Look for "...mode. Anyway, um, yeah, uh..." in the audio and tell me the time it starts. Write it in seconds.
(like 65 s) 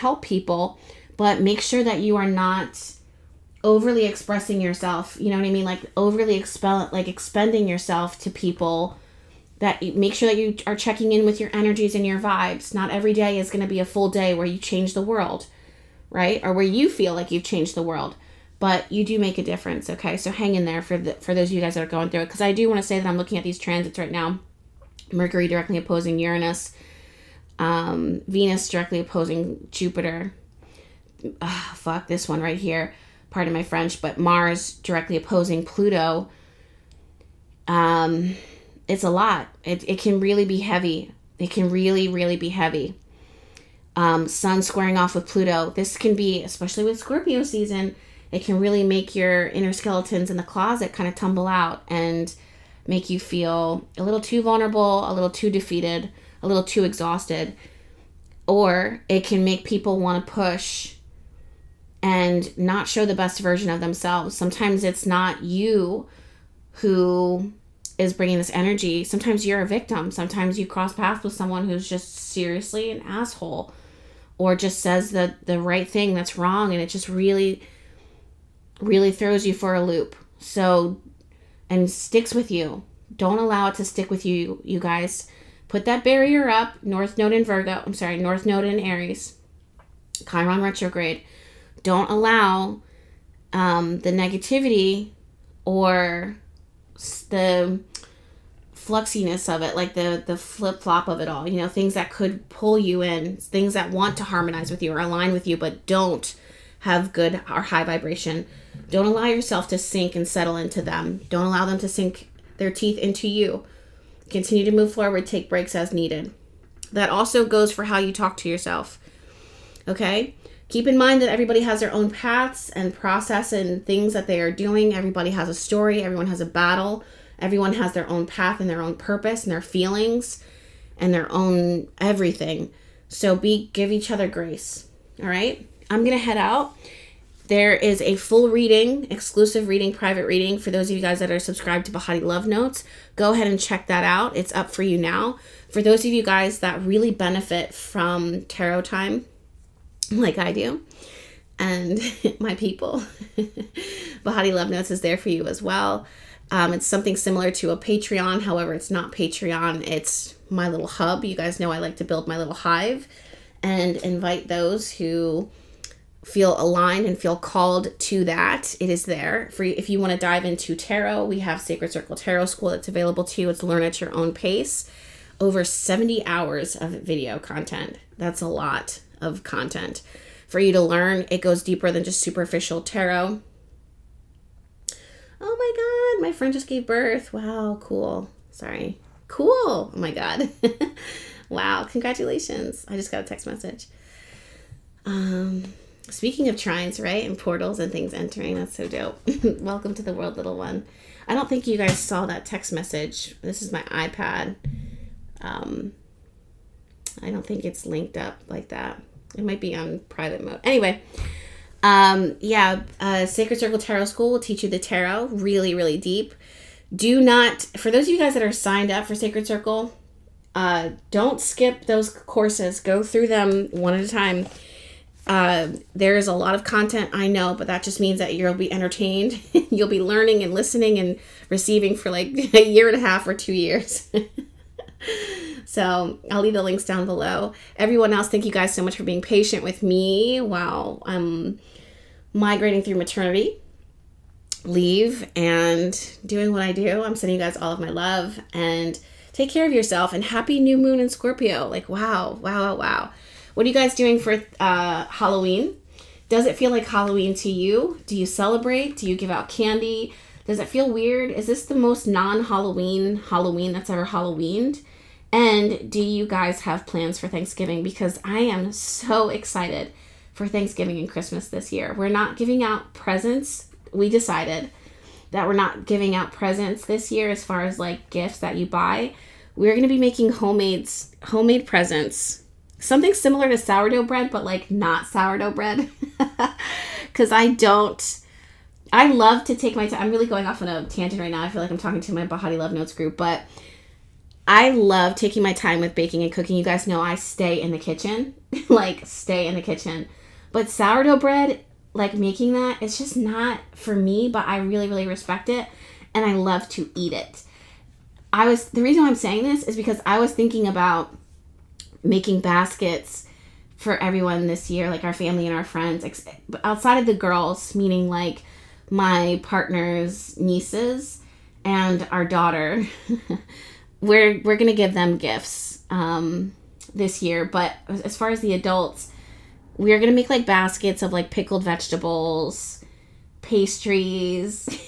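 210 s.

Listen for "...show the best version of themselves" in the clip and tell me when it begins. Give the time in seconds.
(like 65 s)
62 s.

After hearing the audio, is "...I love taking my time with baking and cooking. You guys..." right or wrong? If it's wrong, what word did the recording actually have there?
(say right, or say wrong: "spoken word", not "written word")
right.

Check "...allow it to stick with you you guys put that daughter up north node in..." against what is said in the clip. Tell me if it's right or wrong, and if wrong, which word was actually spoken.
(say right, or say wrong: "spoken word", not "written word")
wrong: "barrier", not "daughter".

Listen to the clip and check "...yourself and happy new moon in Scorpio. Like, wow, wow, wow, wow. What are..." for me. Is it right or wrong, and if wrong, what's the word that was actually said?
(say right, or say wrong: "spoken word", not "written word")
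right.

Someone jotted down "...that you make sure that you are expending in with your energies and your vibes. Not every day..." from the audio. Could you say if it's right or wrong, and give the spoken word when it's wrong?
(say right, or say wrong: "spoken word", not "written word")
wrong: "checking", not "expending".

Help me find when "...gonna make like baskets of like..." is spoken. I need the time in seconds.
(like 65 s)
329 s.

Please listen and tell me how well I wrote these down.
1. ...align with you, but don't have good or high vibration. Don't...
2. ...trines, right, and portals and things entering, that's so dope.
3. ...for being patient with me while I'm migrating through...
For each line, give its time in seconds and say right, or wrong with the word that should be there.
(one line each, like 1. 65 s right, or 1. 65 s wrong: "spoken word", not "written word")
1. 104 s right
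2. 196 s right
3. 238 s right.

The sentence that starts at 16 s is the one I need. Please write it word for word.
Or where you feel like you've changed the world, but you do make a difference, okay?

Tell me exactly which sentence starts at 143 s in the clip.
Go ahead and check that out.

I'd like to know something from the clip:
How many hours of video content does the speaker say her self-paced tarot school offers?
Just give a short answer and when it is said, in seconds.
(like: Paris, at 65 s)
Over 70, at 175 s.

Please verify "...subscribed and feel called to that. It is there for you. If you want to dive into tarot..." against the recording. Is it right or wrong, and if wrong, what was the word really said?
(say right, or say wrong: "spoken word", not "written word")
wrong: "aligned", not "subscribed".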